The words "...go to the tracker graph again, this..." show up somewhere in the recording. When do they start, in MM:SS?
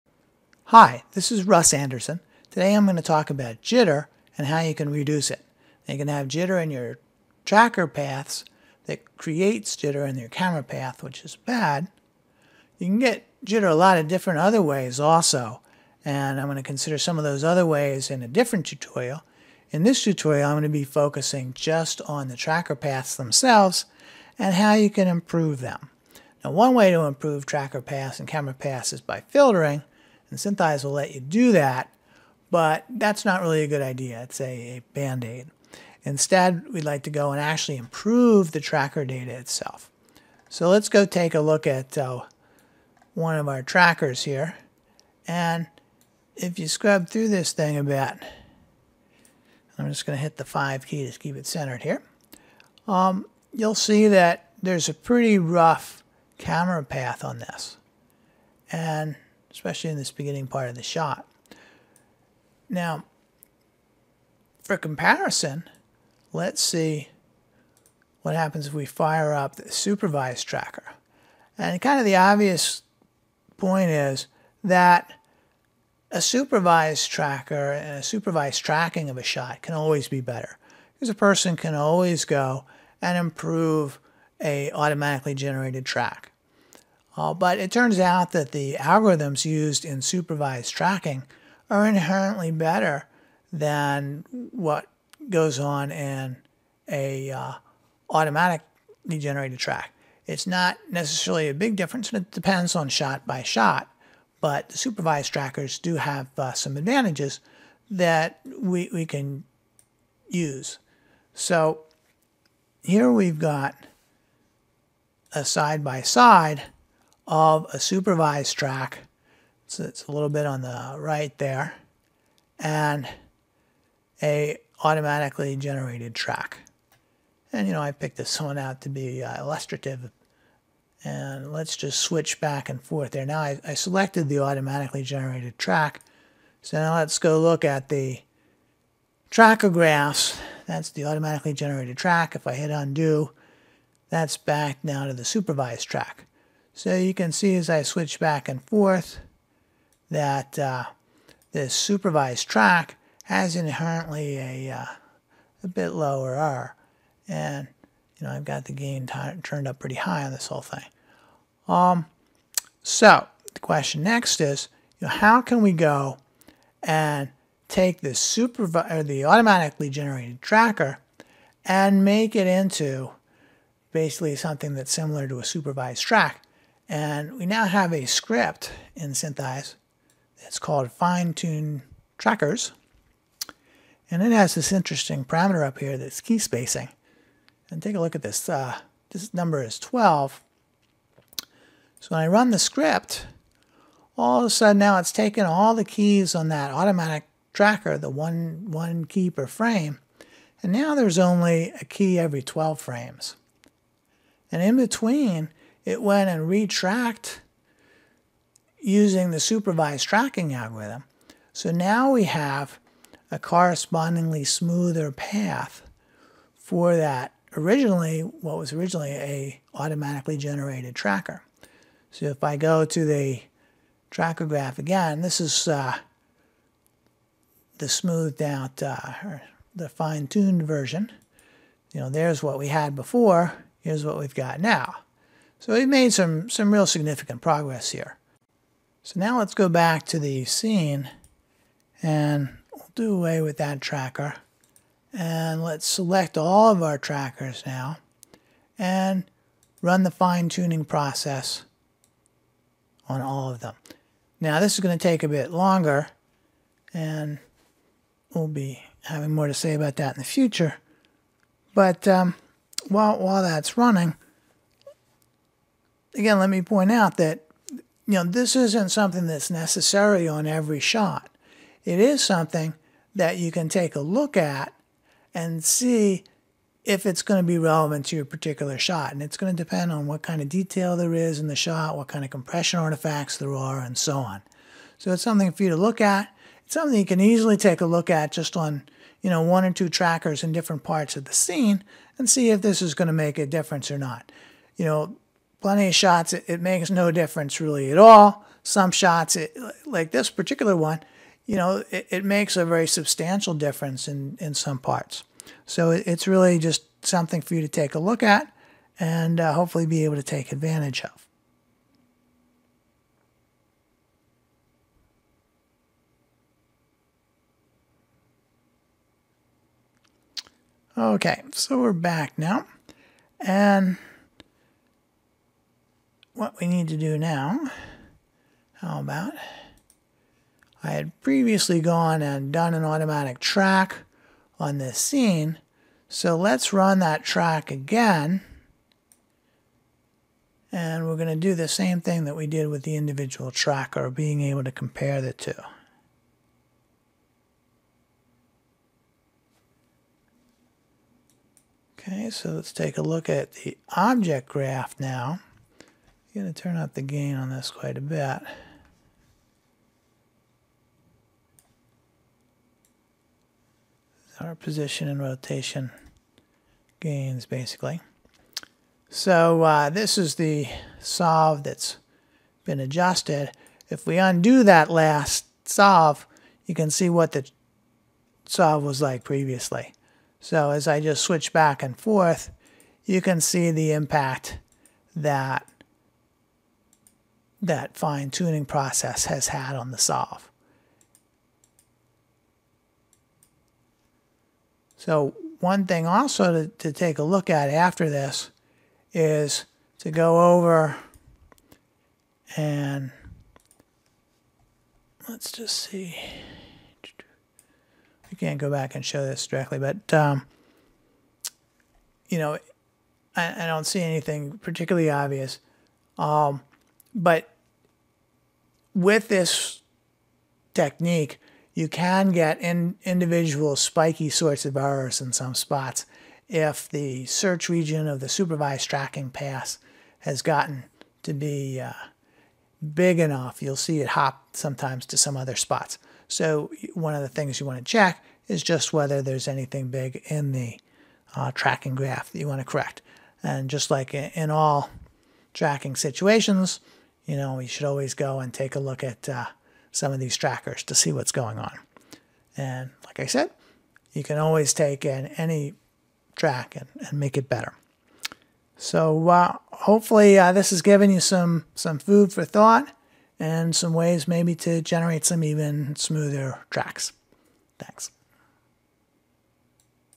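03:42.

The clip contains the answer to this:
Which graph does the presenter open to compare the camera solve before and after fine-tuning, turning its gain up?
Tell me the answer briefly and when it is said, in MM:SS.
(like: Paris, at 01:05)
object graph, at 05:53.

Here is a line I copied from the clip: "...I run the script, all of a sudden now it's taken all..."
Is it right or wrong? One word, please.
right.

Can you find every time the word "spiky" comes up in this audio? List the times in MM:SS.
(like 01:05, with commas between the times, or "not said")
07:03.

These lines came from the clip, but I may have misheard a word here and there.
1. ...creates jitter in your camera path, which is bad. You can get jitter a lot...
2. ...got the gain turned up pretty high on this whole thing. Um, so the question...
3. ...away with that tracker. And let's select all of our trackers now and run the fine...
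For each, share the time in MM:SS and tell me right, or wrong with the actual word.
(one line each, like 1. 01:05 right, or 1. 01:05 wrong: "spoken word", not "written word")
1. 00:09 right
2. 02:38 right
3. 04:03 right.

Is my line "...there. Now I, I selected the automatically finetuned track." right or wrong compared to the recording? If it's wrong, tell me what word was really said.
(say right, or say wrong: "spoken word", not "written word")
wrong: "generated", not "finetuned".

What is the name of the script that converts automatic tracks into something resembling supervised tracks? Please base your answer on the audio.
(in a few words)
fine tune trackers.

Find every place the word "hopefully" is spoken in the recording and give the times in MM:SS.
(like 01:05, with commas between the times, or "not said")
05:09, 07:39.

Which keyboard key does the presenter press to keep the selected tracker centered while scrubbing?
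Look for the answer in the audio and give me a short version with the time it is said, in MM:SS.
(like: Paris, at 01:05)
5, at 00:50.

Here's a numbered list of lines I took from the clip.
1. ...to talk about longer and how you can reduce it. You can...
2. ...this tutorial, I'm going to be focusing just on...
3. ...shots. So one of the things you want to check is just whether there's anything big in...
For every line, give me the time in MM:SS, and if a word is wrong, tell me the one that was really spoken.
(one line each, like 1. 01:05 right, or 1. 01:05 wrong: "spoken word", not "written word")
1. 00:02 wrong: "jitter", not "longer"
2. 00:19 right
3. 07:15 wrong: "spots", not "shots".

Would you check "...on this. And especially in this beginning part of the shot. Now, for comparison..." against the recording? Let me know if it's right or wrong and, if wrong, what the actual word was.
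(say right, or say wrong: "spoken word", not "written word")
right.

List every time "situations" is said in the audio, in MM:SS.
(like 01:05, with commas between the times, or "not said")
07:25.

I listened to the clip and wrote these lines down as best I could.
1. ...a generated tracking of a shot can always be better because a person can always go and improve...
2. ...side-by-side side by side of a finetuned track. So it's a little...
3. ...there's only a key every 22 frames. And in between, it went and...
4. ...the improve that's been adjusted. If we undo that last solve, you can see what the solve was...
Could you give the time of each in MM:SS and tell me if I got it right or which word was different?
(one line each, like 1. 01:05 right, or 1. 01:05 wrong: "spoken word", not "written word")
1. 01:17 wrong: "supervised", not "generated"
2. 01:55 wrong: "supervised", not "finetuned"
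3. 03:20 wrong: "12", not "22"
4. 06:10 wrong: "solve", not "improve".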